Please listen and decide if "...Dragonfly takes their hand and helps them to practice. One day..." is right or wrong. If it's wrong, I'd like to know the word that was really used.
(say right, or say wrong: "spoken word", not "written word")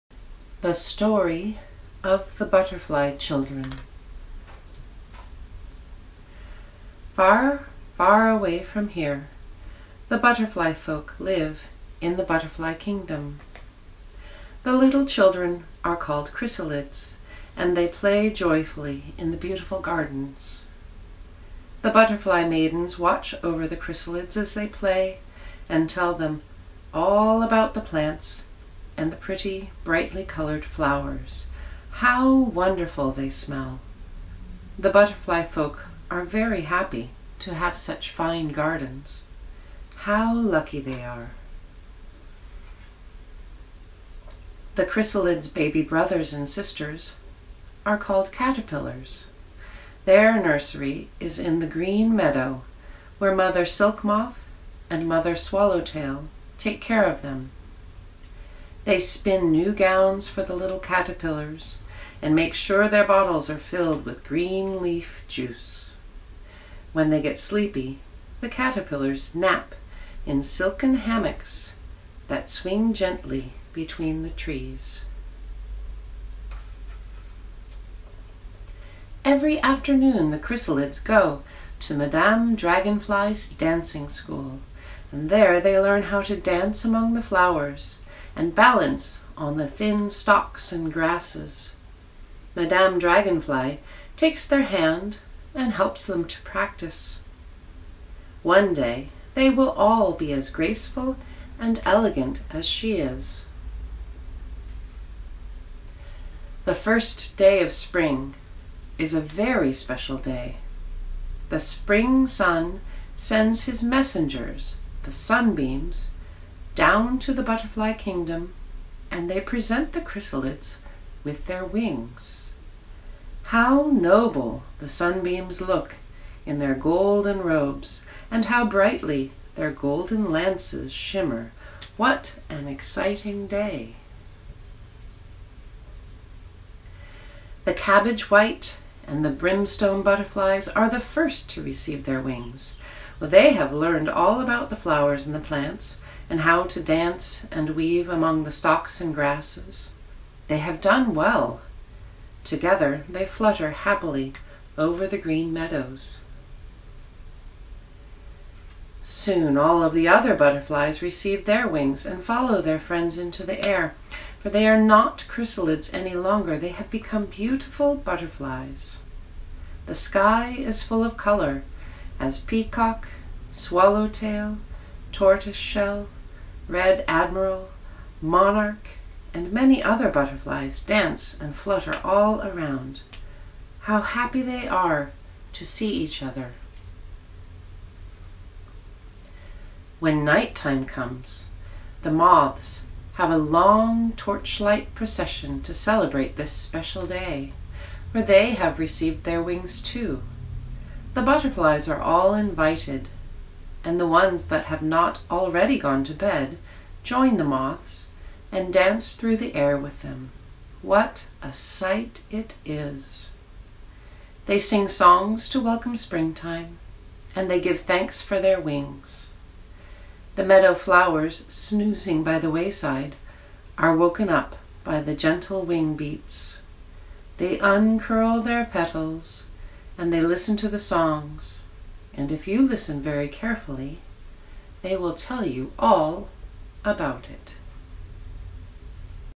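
right.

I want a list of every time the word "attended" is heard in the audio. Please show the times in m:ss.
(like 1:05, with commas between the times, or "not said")
not said.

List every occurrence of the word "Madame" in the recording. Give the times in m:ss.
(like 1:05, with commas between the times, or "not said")
1:21, 1:32.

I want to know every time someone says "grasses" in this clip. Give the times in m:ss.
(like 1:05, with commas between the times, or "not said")
1:30, 2:29.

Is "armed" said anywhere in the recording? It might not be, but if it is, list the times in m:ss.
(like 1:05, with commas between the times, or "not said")
not said.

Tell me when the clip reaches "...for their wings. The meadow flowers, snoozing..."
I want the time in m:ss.
3:38.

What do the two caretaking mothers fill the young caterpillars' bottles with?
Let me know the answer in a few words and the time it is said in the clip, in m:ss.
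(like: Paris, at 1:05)
green leaf juice, at 1:04.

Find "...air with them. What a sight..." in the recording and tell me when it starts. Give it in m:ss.
3:29.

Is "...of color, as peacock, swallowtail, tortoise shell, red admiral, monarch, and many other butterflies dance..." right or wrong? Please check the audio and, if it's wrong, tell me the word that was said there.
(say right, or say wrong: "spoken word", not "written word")
right.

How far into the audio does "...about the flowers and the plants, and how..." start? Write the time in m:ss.
2:24.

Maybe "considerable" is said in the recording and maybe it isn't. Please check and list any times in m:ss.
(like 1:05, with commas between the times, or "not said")
not said.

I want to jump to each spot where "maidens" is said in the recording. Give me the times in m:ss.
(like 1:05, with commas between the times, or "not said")
0:22.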